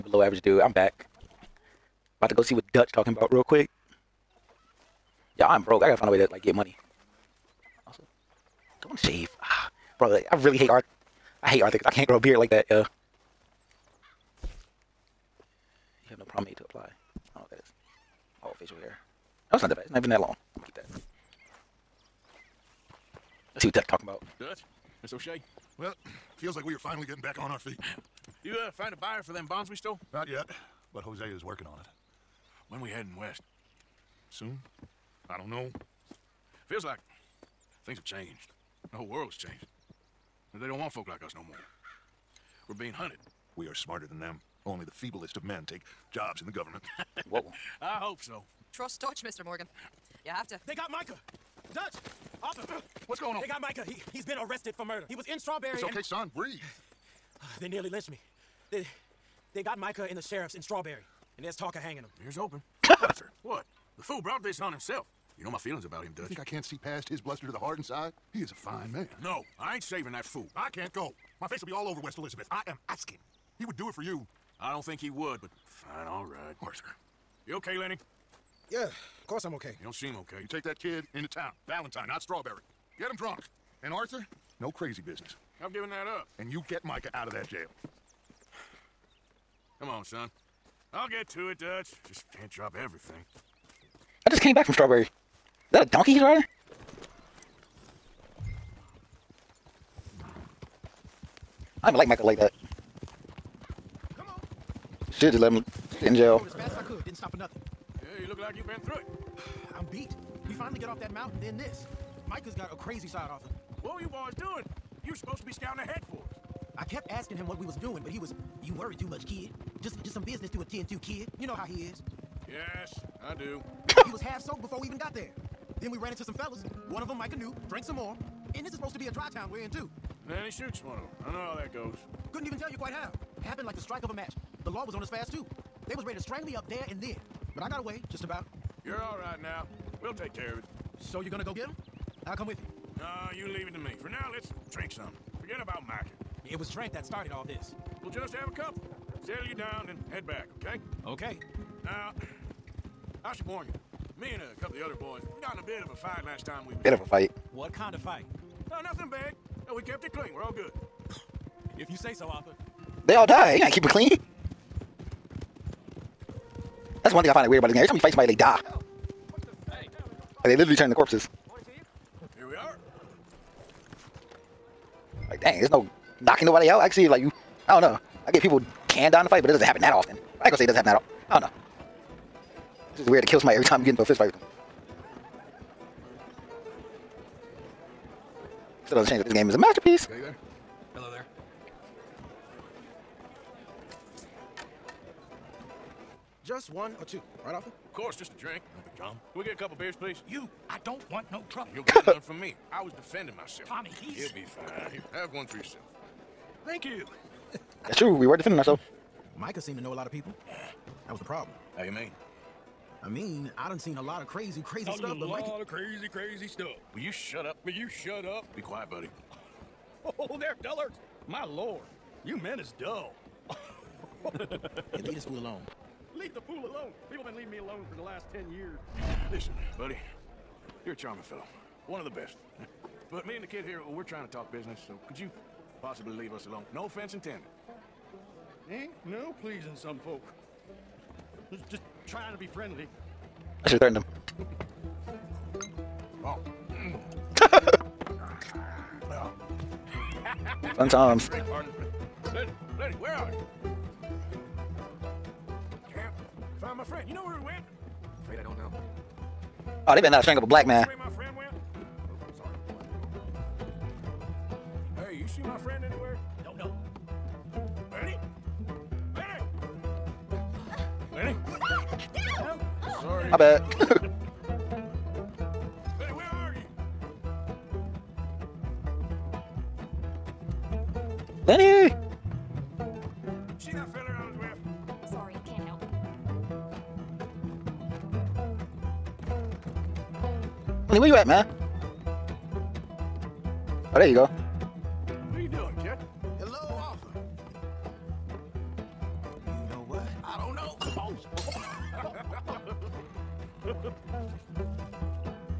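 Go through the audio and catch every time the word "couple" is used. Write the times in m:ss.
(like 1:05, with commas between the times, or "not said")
2:34, 3:19.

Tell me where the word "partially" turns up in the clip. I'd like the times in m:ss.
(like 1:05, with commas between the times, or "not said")
not said.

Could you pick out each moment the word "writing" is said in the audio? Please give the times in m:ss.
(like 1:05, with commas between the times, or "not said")
not said.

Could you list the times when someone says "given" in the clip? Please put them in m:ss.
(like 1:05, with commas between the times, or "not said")
1:25.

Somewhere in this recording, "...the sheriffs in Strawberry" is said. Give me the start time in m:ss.
1:00.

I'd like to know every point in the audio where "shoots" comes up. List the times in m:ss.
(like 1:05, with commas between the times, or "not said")
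2:10.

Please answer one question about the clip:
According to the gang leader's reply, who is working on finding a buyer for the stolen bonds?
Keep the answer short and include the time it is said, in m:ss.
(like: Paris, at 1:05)
Josiah, at 0:31.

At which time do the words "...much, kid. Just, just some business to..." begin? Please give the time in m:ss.
1:59.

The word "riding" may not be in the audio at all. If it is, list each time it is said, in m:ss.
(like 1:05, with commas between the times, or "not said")
1:36.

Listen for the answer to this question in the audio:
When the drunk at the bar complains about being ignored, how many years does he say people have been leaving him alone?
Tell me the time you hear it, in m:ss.
3:48.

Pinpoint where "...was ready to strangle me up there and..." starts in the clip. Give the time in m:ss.
2:15.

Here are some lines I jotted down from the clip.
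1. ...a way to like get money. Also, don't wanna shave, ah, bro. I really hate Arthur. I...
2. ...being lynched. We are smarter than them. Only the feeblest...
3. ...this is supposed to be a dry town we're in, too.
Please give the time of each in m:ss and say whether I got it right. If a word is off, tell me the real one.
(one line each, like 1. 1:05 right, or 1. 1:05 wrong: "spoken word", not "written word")
1. 0:06 right
2. 0:42 wrong: "hunted", not "lynched"
3. 2:08 right.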